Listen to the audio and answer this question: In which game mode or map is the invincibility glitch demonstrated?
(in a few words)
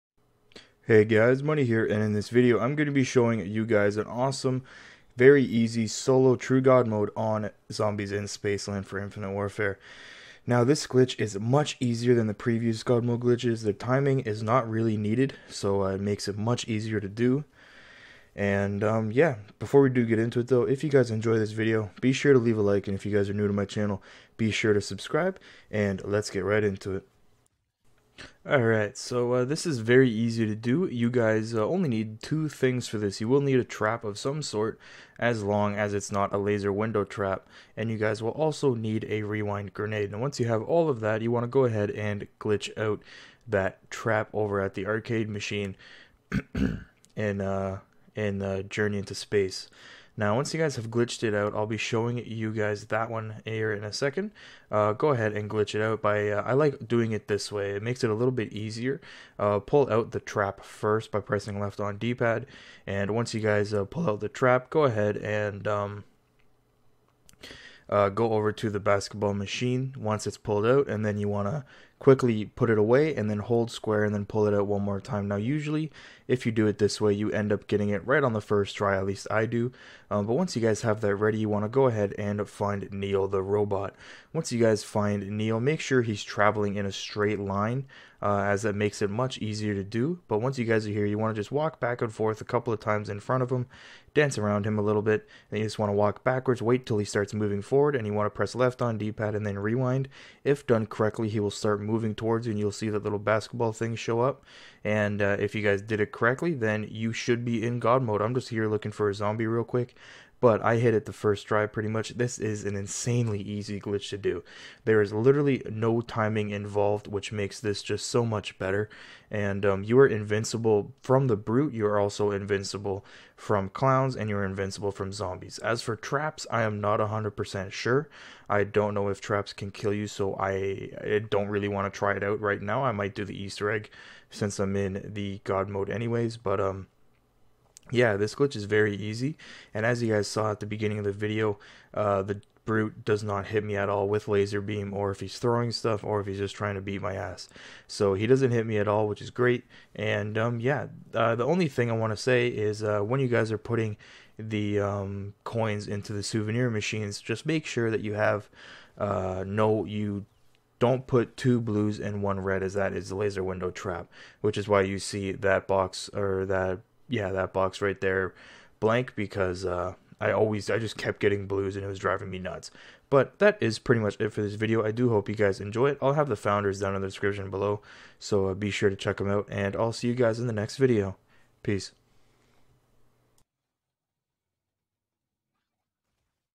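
Zombies in Spaceland.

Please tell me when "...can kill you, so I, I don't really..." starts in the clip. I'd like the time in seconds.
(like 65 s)
129 s.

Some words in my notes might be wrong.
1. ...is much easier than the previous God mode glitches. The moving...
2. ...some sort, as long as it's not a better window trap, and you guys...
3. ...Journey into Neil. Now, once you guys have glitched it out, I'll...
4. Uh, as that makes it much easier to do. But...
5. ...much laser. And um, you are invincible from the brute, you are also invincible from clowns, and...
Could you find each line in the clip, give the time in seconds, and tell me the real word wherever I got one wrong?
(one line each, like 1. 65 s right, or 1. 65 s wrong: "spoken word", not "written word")
1. 11 s wrong: "timing", not "moving"
2. 34 s wrong: "laser", not "better"
3. 48 s wrong: "Space", not "Neil"
4. 88 s right
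5. 118 s wrong: "better", not "laser".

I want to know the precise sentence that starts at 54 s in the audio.
Uh, go ahead and glitch it out by, uh, I like doing it this way.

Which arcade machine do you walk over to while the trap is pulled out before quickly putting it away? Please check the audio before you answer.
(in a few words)
Basketball machine.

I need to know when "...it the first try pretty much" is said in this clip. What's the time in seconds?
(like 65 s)
110 s.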